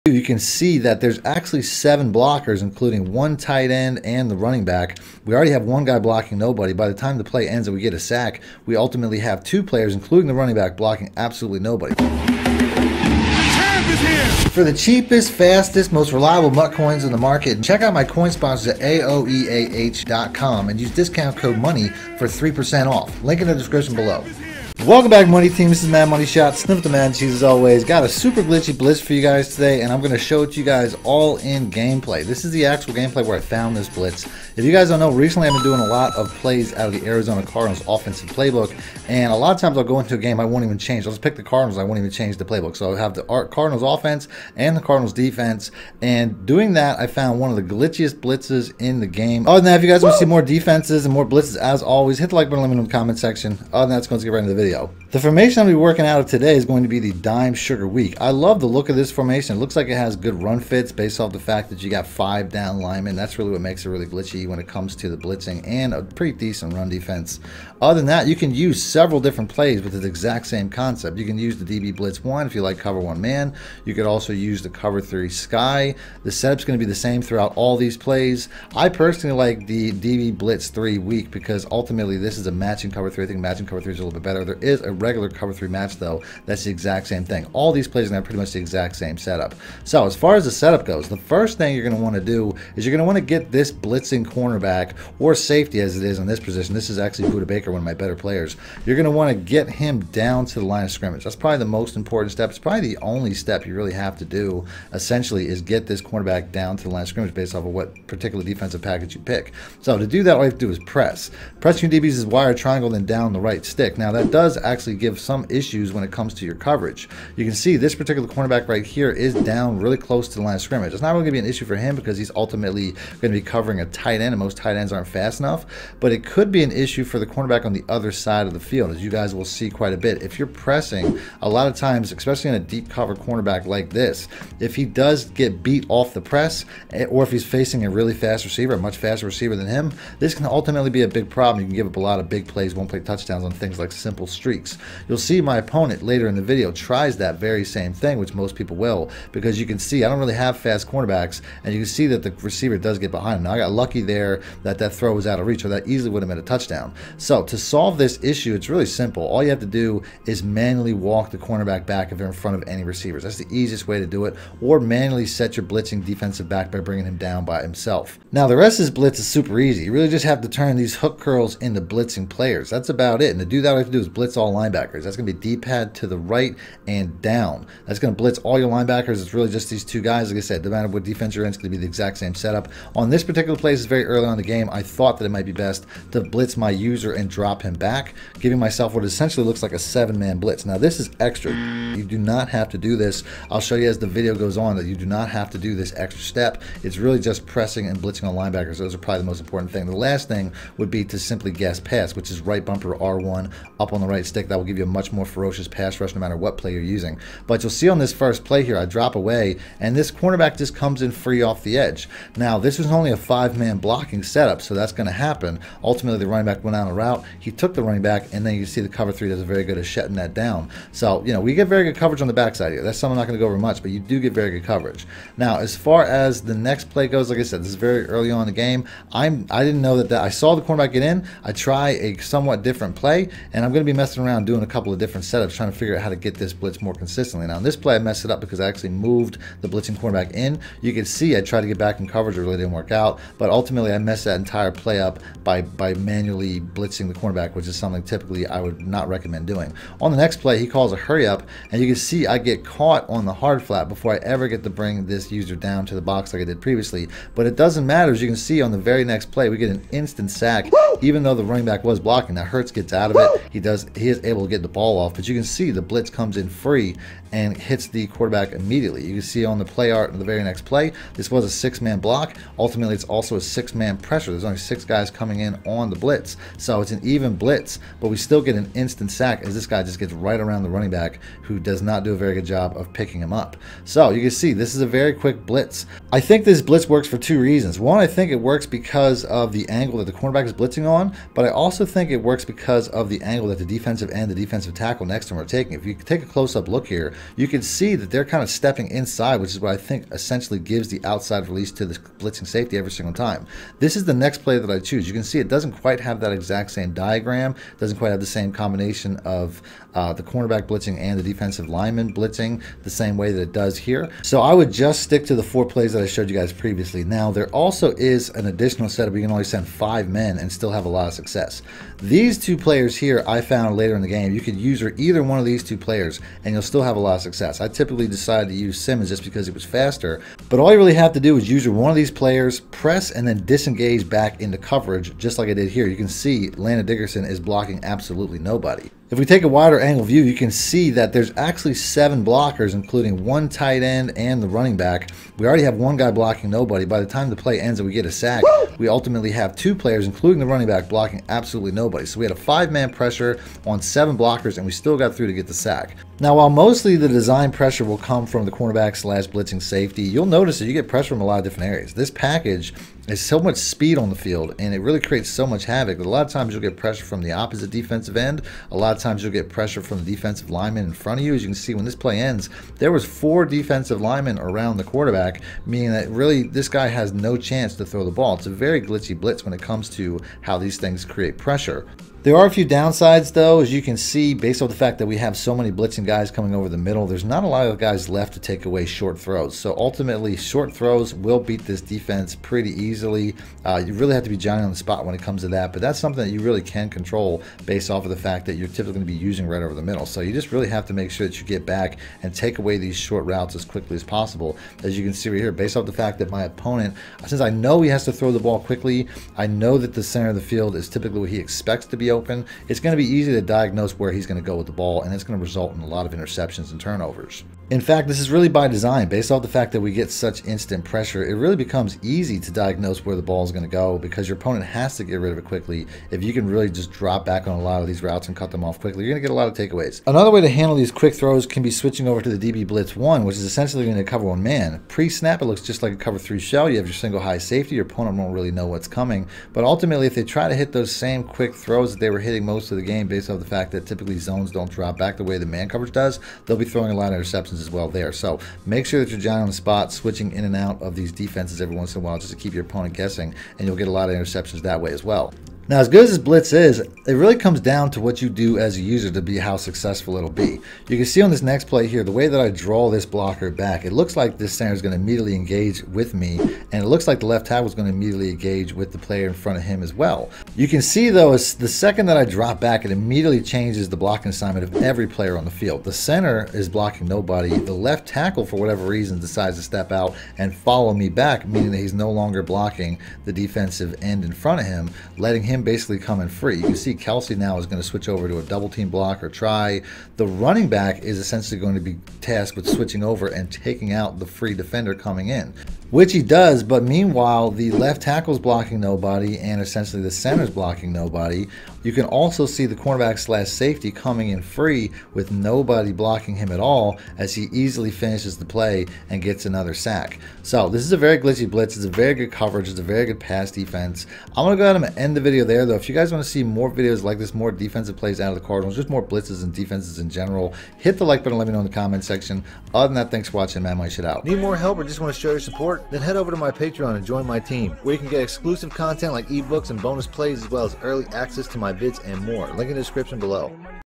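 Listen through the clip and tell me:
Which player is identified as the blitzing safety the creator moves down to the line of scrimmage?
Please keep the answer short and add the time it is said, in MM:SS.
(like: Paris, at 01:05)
Budda Baker, at 01:37.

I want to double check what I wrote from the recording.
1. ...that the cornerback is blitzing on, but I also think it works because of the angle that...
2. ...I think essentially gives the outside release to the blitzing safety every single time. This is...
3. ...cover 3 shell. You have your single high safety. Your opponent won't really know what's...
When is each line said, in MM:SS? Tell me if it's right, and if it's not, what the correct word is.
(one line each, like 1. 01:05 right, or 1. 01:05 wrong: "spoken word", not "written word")
1. 04:49 right
2. 04:59 right
3. 07:15 right.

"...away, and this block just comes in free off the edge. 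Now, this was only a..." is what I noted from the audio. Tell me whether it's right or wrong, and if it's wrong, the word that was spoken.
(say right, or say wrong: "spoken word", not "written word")
wrong: "cornerback", not "block".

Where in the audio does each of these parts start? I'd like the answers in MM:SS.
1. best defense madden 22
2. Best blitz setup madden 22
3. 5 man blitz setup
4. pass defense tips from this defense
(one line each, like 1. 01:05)
1. 00:55
2. 01:29
3. 05:17
4. 06:22.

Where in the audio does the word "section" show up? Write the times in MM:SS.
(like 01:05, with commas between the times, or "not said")
00:53, 08:42.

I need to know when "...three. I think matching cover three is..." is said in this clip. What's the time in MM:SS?
01:23.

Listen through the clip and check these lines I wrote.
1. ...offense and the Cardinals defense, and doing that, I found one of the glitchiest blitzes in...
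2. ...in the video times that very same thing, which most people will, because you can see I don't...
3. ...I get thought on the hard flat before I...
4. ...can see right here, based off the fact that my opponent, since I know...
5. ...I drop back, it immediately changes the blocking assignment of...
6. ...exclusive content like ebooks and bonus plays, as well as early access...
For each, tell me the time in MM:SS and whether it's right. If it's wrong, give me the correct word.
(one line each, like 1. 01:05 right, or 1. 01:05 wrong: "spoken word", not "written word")
1. 00:43 right
2. 02:26 wrong: "tries", not "times"
3. 04:12 wrong: "caught", not "thought"
4. 06:45 right
5. 07:52 right
6. 08:48 right.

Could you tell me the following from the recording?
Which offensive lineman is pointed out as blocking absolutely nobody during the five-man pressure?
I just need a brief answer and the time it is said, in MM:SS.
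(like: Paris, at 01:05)
Landon Dickerson, at 05:36.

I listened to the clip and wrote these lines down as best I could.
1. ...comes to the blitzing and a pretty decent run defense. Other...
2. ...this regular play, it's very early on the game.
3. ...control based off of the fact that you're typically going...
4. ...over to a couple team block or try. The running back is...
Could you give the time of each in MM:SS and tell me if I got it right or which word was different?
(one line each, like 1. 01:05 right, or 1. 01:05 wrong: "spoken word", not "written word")
1. 01:04 right
2. 03:03 wrong: "particular", not "regular"
3. 06:36 right
4. 08:08 wrong: "double", not "couple".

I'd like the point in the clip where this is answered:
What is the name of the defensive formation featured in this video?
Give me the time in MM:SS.
00:57.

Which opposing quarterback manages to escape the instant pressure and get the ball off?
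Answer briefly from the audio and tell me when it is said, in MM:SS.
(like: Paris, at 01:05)
Hurts, at 04:22.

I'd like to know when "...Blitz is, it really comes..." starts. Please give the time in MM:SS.
07:36.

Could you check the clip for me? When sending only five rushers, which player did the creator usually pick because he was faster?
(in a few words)
Simmons.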